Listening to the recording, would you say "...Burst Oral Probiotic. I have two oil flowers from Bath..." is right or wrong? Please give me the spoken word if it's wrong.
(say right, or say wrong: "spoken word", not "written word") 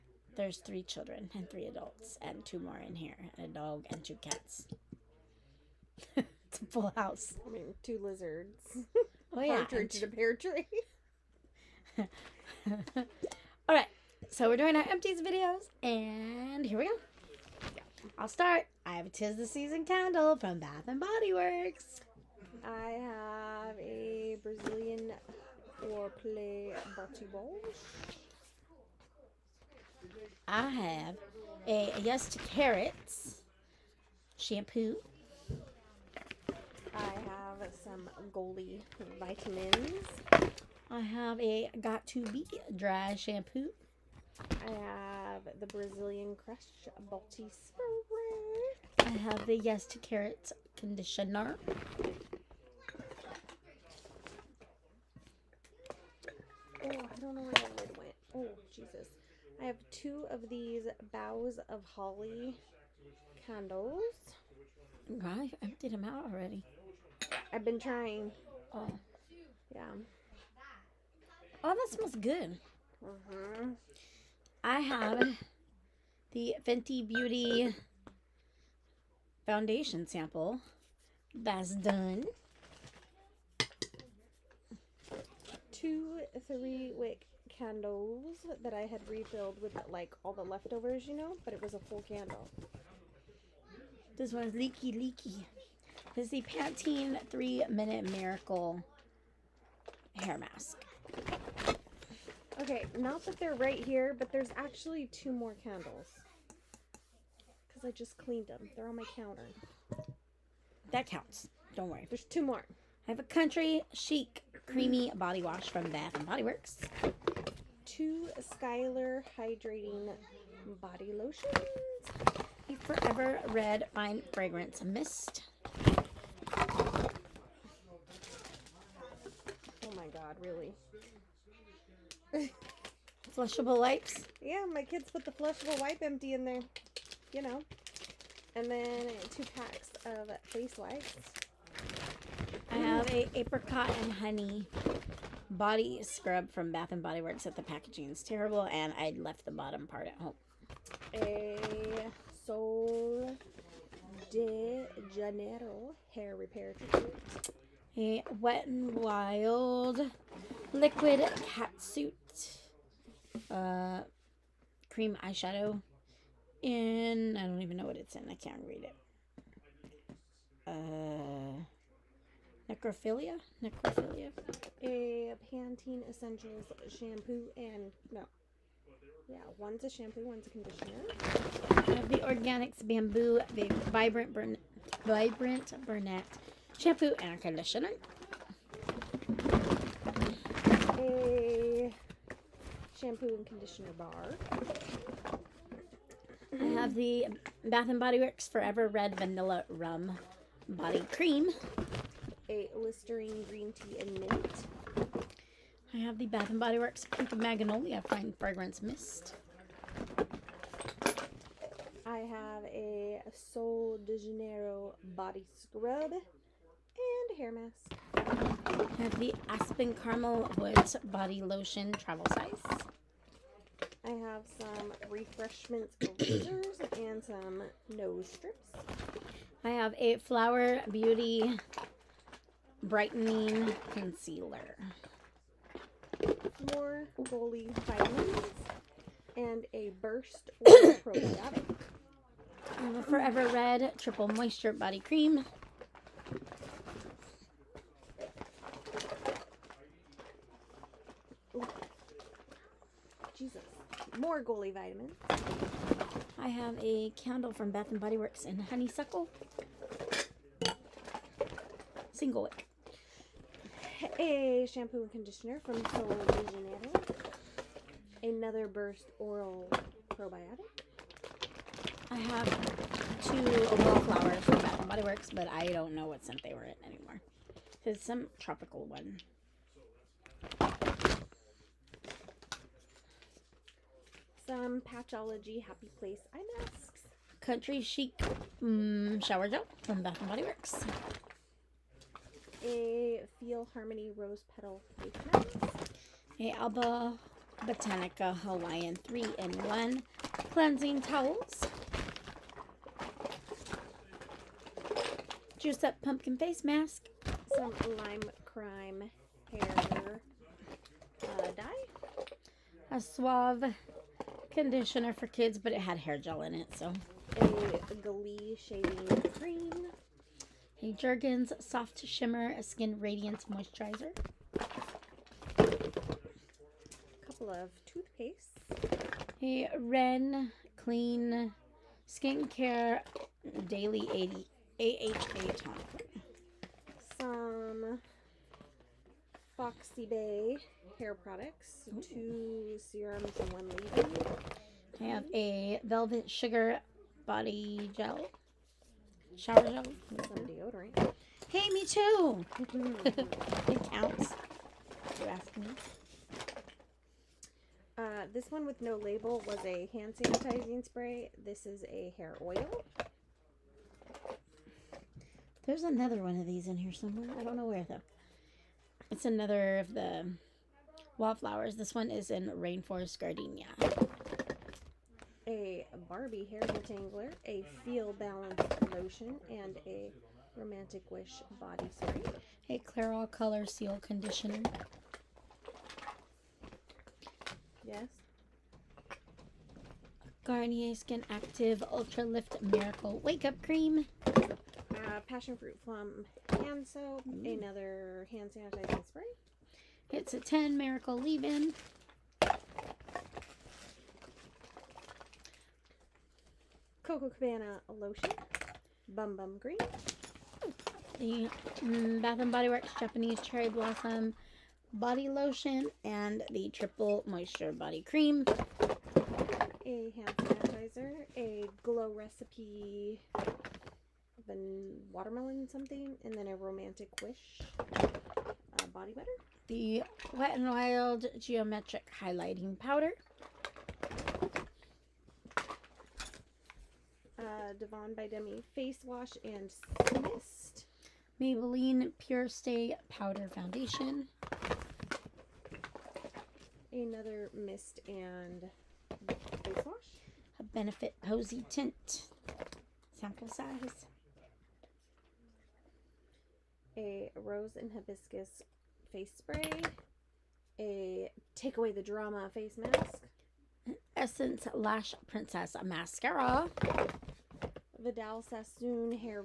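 right.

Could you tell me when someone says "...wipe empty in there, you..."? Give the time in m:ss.
2:15.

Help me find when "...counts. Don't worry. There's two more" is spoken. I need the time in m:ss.
1:51.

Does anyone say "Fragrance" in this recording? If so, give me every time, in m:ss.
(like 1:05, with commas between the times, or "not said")
2:04, 3:28.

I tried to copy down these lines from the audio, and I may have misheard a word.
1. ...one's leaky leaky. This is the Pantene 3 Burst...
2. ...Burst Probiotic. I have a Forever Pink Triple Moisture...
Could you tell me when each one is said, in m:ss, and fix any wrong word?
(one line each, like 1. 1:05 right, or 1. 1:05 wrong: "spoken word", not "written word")
1. 1:34 wrong: "Minute", not "Burst"
2. 4:00 wrong: "Red", not "Pink".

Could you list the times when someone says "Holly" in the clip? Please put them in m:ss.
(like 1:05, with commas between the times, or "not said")
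1:01.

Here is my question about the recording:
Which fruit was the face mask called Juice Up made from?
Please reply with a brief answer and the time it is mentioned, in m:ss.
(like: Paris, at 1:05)
Pumpkin, at 5:06.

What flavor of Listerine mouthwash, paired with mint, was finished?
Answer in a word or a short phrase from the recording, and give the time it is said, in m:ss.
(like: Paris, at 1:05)
Green Tea, at 3:23.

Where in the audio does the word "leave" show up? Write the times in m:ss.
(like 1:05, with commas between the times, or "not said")
5:43, 6:41.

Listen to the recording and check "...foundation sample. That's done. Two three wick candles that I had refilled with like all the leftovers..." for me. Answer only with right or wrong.
right.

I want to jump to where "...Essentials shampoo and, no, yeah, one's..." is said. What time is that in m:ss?
2:56.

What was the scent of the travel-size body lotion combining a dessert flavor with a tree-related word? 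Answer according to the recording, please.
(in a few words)
Aspen Caramel Woods.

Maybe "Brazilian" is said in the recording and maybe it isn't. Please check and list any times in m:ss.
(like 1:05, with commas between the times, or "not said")
0:24, 0:45.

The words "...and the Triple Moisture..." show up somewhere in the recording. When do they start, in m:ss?
6:56.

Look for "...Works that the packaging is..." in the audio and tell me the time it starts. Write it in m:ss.
2:27.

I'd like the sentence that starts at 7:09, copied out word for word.
The Wet and Wild Geometric Highlighting Powder.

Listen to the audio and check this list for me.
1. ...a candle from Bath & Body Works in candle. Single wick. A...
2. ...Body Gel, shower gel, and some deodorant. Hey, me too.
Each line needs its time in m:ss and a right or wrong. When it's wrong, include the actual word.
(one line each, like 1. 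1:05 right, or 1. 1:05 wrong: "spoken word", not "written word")
1. 4:16 wrong: "honeysuckle", not "candle"
2. 5:47 right.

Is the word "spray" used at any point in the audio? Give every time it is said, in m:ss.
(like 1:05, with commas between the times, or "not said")
0:47, 6:00, 6:21, 6:39, 7:39.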